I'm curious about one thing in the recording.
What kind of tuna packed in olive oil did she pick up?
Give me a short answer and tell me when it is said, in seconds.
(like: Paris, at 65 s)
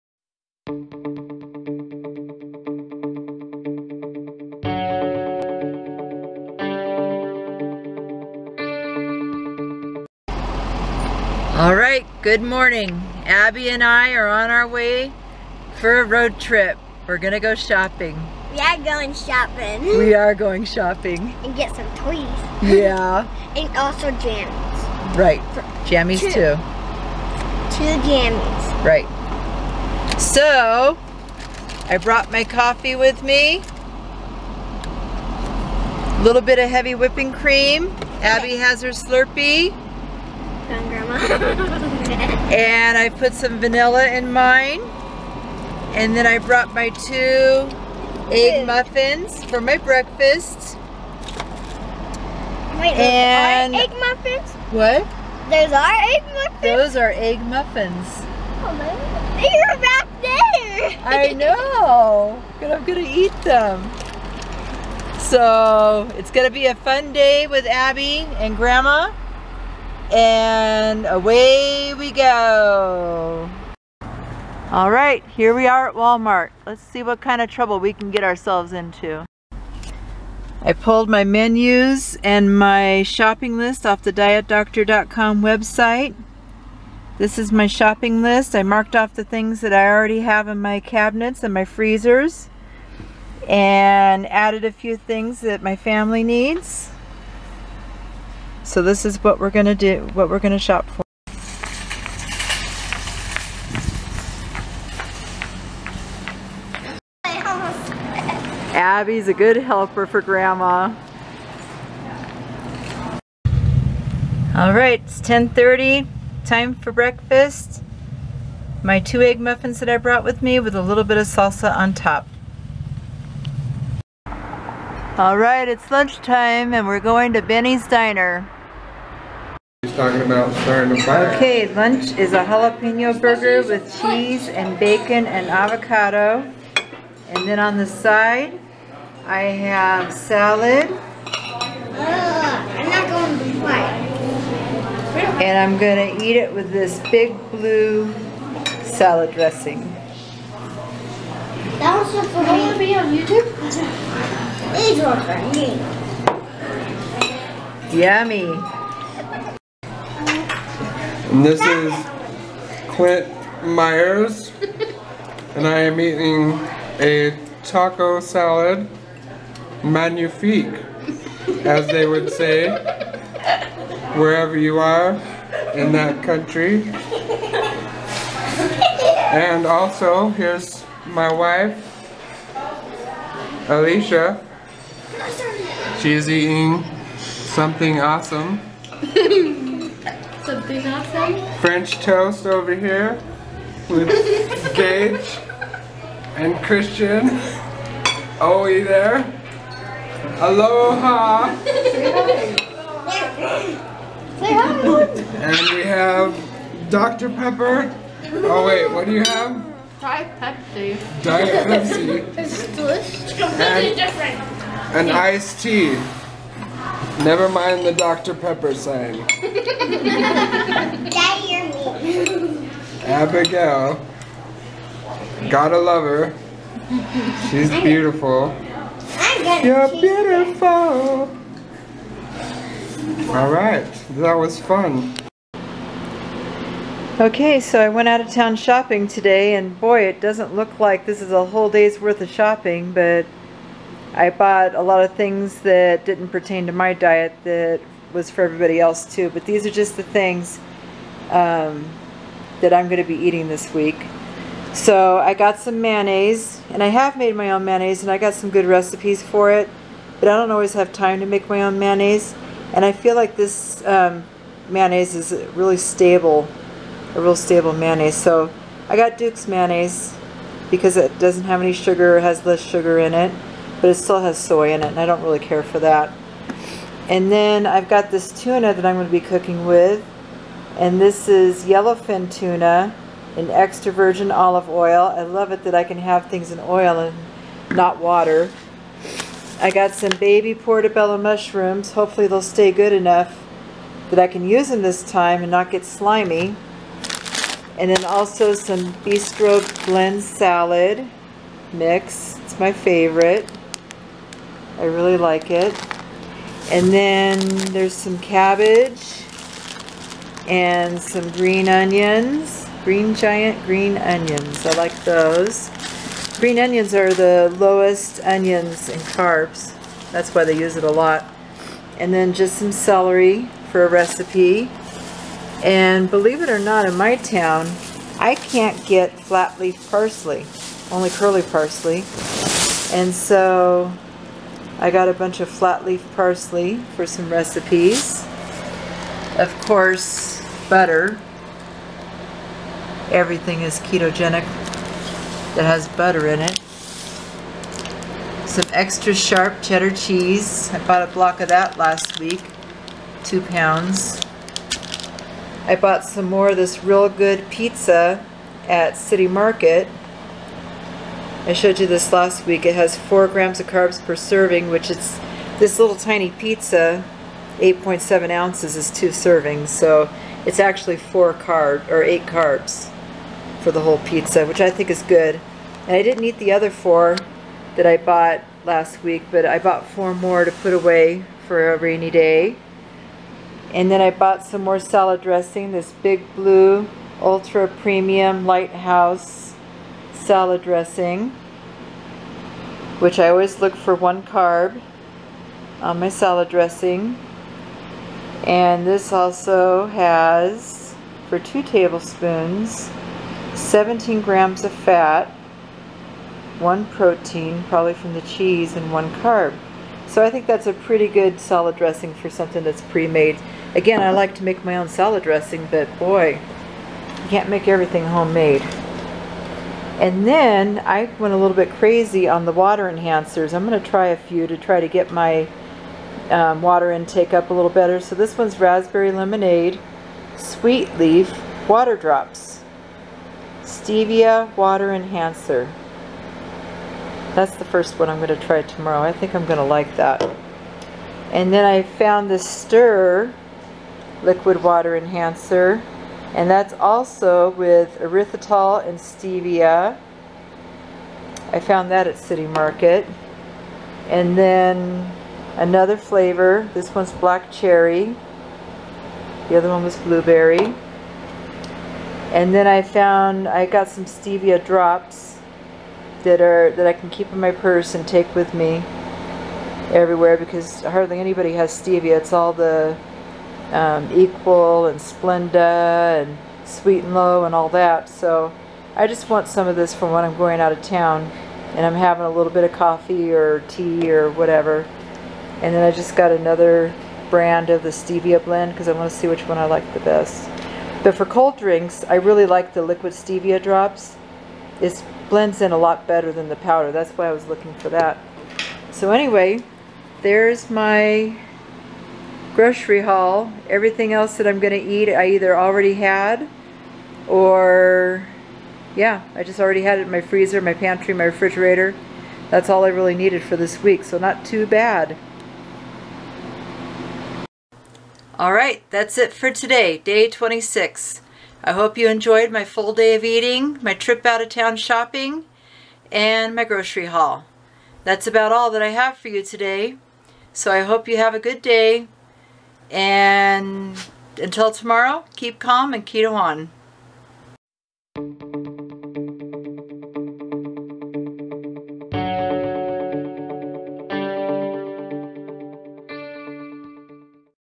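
Yellowfin, at 281 s.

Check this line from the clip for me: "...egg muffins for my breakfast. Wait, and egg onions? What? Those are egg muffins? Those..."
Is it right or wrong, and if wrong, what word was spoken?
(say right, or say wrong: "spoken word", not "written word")
wrong: "muffins", not "onions".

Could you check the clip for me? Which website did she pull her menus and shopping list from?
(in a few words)
dietdoctor.com.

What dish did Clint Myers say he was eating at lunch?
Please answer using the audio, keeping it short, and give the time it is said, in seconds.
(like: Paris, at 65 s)
Taco salad, at 167 s.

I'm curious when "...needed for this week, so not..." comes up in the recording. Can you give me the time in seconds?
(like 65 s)
513 s.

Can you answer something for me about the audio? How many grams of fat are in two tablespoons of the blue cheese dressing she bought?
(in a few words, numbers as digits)
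17 grams.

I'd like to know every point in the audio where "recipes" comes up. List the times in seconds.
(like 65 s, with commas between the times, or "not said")
258 s, 323 s, 337 s.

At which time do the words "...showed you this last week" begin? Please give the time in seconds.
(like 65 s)
361 s.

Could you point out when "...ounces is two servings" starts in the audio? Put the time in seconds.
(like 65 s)
368 s.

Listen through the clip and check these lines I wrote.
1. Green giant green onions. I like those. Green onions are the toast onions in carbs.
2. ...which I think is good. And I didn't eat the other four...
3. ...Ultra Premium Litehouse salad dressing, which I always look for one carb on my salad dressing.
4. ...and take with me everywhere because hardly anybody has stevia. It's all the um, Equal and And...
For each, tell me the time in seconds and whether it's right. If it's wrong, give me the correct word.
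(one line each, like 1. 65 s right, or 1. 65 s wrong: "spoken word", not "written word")
1. 312 s wrong: "lowest", not "toast"
2. 374 s right
3. 387 s right
4. 467 s wrong: "Splenda", not "And".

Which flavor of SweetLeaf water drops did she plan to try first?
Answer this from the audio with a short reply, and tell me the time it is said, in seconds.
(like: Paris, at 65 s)
Raspberry lemonade, at 428 s.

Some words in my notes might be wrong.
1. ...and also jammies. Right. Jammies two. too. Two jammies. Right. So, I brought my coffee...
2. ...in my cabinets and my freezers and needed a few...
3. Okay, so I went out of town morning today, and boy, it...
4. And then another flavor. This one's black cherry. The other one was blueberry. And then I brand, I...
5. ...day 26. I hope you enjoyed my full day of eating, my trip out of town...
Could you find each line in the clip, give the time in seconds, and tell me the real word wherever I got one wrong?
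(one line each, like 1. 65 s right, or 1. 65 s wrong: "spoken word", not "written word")
1. 23 s right
2. 90 s wrong: "added", not "needed"
3. 237 s wrong: "shopping", not "morning"
4. 454 s wrong: "found", not "brand"
5. 519 s right.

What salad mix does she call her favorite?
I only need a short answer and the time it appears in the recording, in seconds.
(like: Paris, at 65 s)
Bistro blend, at 299 s.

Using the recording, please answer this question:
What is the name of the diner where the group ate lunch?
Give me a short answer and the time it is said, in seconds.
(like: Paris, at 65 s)
Benny's Diner, at 127 s.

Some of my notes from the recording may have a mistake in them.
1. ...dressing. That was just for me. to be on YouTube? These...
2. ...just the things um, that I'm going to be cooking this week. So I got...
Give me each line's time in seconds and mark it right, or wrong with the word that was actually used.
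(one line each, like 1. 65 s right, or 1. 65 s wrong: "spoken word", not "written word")
1. 149 s right
2. 249 s wrong: "eating", not "cooking".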